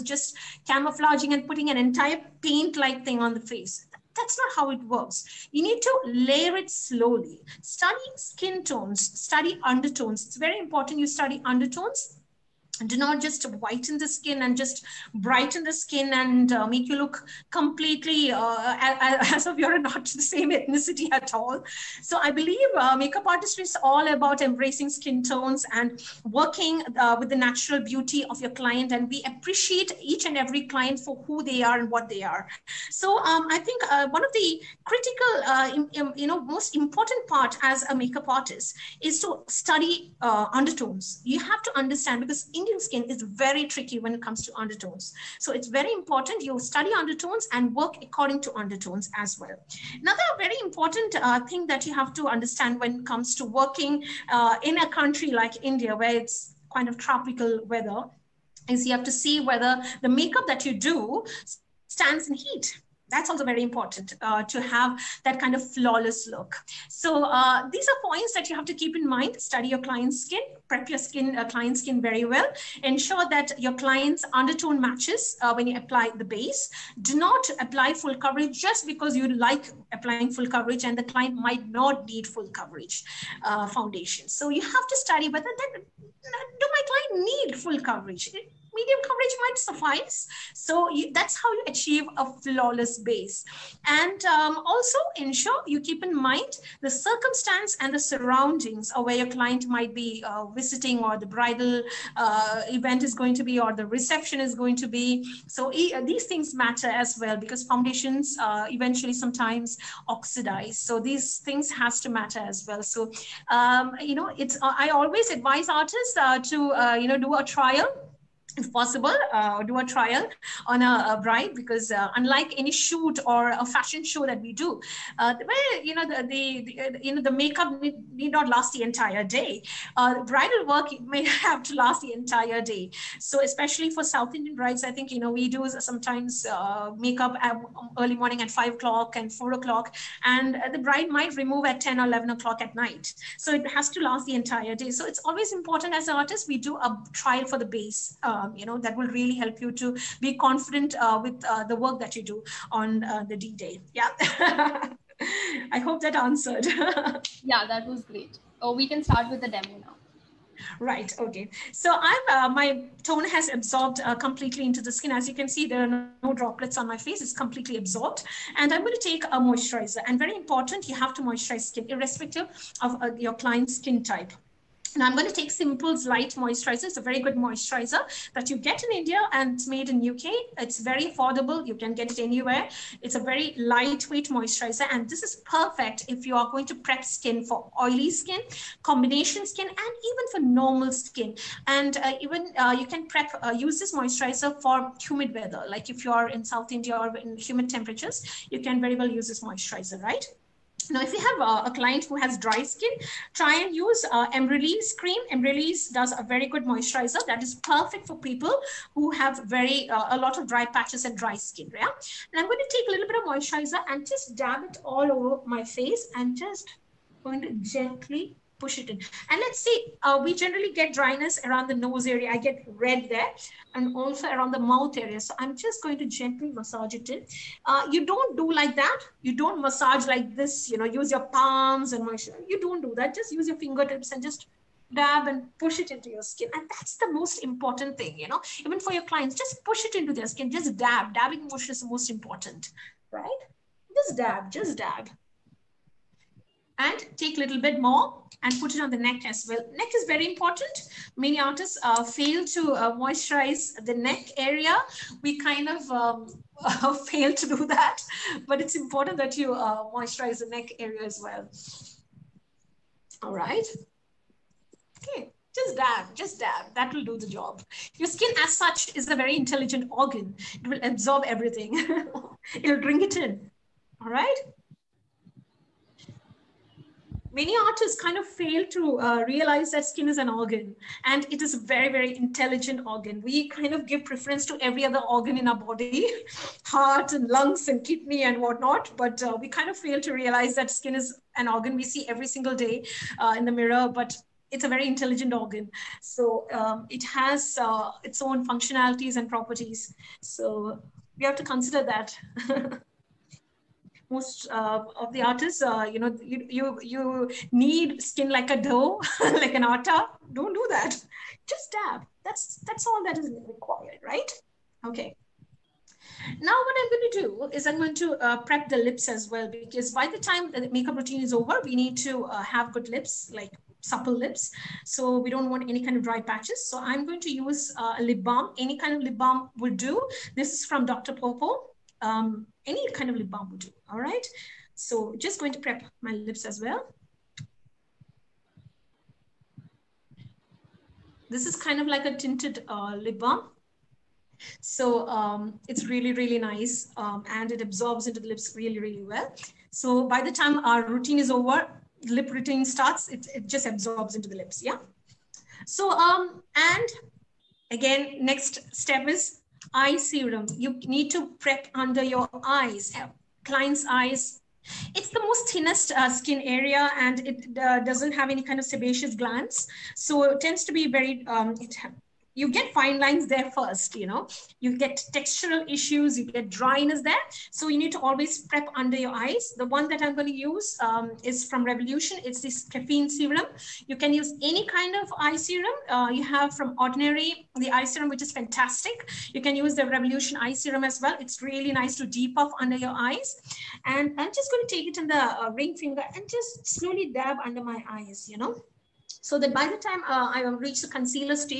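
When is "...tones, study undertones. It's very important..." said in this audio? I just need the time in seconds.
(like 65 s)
8 s.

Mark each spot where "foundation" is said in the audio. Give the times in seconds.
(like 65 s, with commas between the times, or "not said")
83 s, 107 s.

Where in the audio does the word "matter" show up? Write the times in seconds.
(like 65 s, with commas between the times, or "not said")
106 s, 112 s.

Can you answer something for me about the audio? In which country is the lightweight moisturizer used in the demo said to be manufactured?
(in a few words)
UK.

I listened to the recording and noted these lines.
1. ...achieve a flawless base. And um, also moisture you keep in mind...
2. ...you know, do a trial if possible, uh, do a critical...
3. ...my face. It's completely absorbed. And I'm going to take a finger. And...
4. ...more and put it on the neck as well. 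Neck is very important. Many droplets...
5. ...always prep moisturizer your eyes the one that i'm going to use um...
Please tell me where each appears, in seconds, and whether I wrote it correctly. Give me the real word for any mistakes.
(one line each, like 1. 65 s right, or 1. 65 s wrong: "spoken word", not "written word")
1. 91 s wrong: "ensure", not "moisture"
2. 116 s wrong: "trial", not "critical"
3. 166 s wrong: "moisturizer", not "finger"
4. 247 s wrong: "artists", not "droplets"
5. 377 s wrong: "under", not "moisturizer".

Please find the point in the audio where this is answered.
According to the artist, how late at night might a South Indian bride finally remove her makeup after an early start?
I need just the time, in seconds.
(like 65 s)
142 s.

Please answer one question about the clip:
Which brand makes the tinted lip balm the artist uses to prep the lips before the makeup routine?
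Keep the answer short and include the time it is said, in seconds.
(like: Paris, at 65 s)
Dr. PAWPAW, at 330 s.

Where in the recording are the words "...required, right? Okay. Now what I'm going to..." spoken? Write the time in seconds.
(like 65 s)
313 s.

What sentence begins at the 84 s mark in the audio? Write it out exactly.
So you have to study whether that, do my client need full coverage?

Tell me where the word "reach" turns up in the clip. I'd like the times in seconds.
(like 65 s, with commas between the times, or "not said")
400 s.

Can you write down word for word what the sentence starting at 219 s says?
And let's see, uh, we generally get dryness around the nose area.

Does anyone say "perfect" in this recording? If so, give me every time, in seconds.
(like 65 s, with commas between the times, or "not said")
185 s, 207 s.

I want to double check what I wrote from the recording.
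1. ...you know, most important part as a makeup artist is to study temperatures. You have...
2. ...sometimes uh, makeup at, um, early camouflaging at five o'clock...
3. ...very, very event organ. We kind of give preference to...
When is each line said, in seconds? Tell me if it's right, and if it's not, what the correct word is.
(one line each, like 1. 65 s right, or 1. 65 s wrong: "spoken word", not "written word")
1. 36 s wrong: "undertones", not "temperatures"
2. 135 s wrong: "morning", not "camouflaging"
3. 281 s wrong: "intelligent", not "event".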